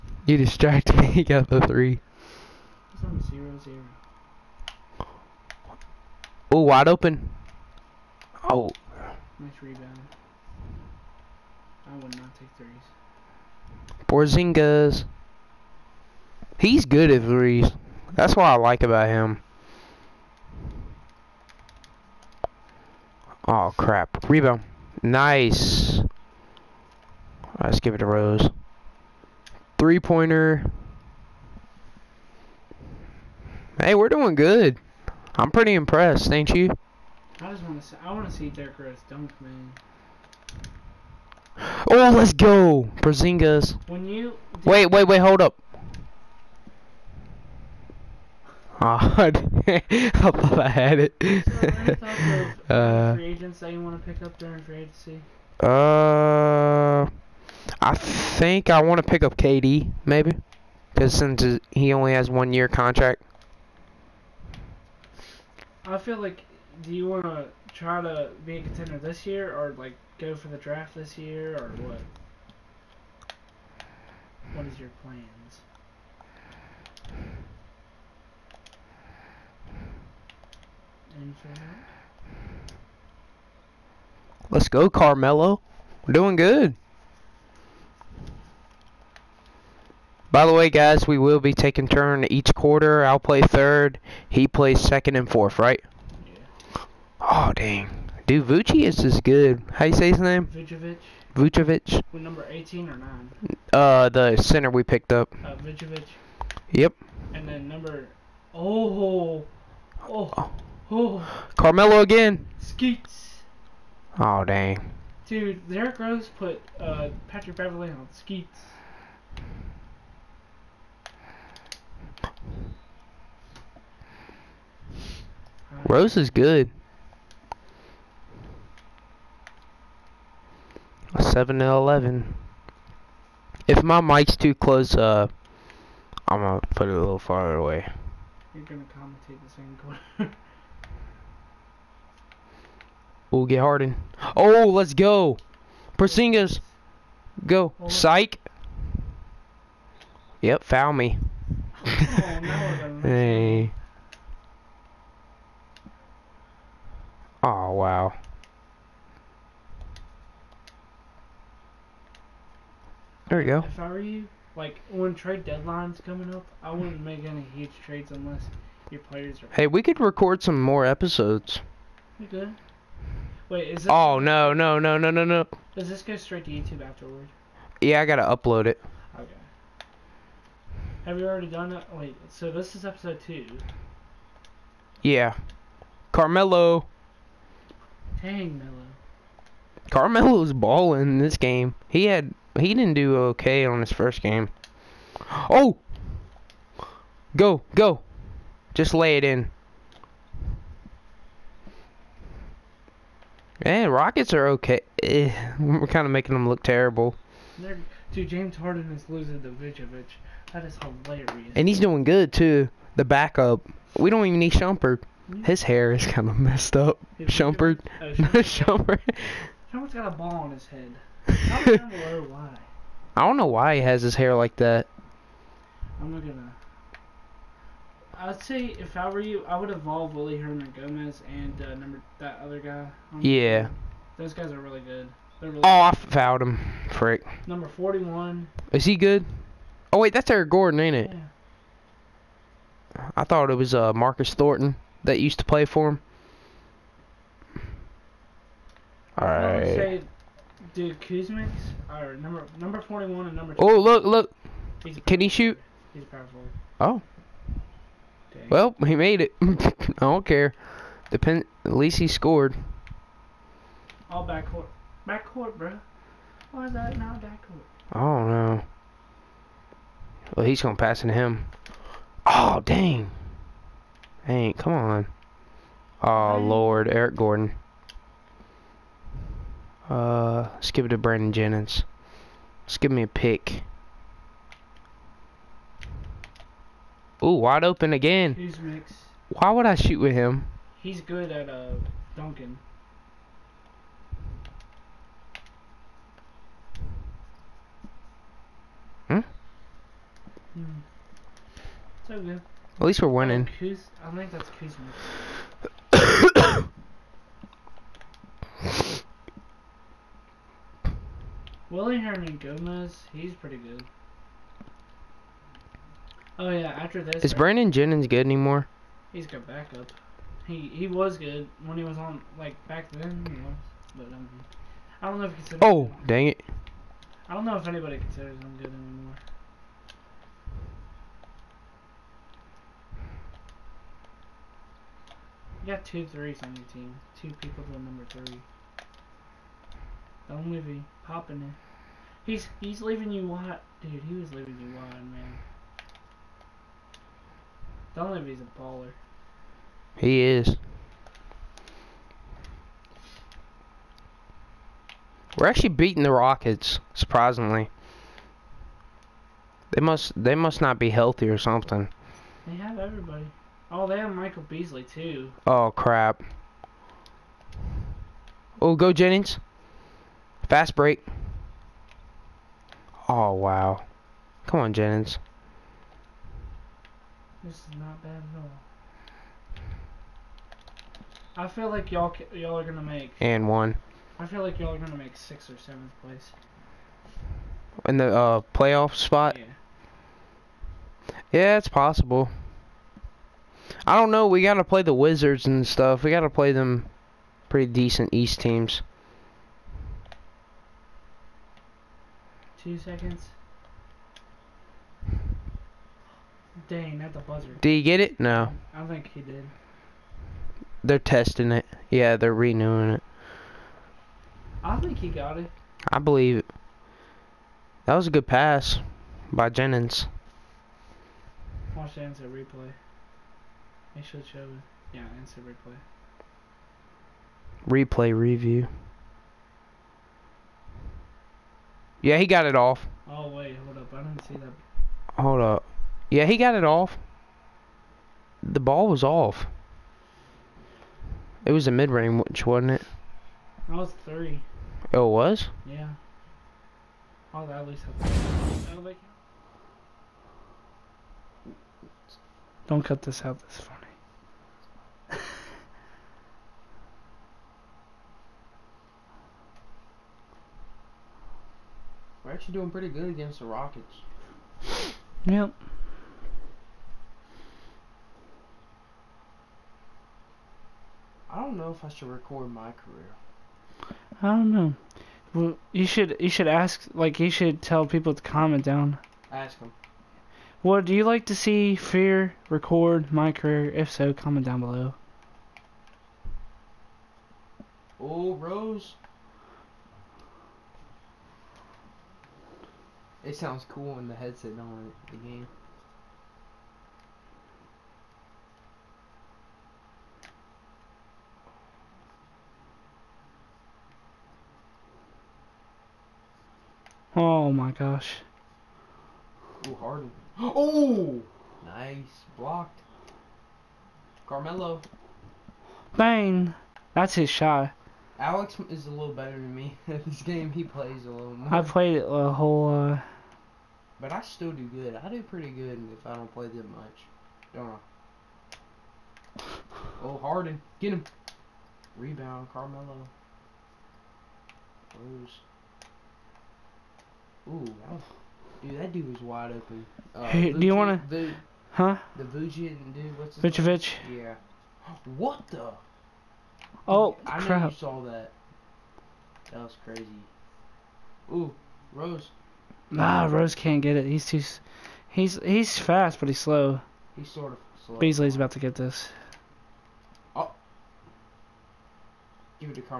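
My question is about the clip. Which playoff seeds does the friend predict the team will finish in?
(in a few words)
sixth or seventh.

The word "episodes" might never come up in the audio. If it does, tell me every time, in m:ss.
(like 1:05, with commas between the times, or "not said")
2:50, 3:02.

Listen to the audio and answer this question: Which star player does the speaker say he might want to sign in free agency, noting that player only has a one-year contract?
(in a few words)
KD.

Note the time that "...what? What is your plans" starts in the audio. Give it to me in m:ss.
1:11.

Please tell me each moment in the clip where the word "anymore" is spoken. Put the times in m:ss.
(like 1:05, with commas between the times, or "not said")
5:18, 5:28.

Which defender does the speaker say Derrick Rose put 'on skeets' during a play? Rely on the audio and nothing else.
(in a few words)
Patrick Beverley.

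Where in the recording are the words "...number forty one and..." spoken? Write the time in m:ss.
4:12.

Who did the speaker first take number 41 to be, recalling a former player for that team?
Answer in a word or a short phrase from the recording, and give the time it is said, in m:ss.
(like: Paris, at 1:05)
Marcus Thornton, at 4:03.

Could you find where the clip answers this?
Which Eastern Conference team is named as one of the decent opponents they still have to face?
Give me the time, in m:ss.
6:34.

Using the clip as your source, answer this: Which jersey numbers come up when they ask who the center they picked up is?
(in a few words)
18 or 9.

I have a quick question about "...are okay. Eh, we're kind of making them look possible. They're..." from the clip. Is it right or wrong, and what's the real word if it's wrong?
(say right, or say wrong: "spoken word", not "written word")
wrong: "terrible", not "possible".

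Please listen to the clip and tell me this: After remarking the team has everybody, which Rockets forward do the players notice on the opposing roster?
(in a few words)
Michael Beasley.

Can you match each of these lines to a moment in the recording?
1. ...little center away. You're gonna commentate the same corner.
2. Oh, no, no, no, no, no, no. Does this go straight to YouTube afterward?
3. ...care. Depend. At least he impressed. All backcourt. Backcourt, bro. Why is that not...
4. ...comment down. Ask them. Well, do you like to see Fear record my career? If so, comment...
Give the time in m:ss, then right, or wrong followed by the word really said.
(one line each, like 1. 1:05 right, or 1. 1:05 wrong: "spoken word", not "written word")
1. 2:16 wrong: "farther", not "center"
2. 2:53 right
3. 4:20 wrong: "scored", not "impressed"
4. 7:58 right.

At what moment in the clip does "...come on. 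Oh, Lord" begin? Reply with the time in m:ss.
4:34.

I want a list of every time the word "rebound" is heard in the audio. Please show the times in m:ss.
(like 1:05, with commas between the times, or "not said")
0:09, 0:24, 8:51.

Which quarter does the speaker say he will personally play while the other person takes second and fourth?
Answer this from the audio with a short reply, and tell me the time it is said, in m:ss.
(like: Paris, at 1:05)
third, at 1:33.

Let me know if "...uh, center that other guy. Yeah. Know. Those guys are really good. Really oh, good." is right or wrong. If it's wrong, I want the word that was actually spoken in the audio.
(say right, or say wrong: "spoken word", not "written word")
wrong: "number", not "center".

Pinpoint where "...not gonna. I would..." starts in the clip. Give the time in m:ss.
3:46.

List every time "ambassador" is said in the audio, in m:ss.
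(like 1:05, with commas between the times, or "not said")
not said.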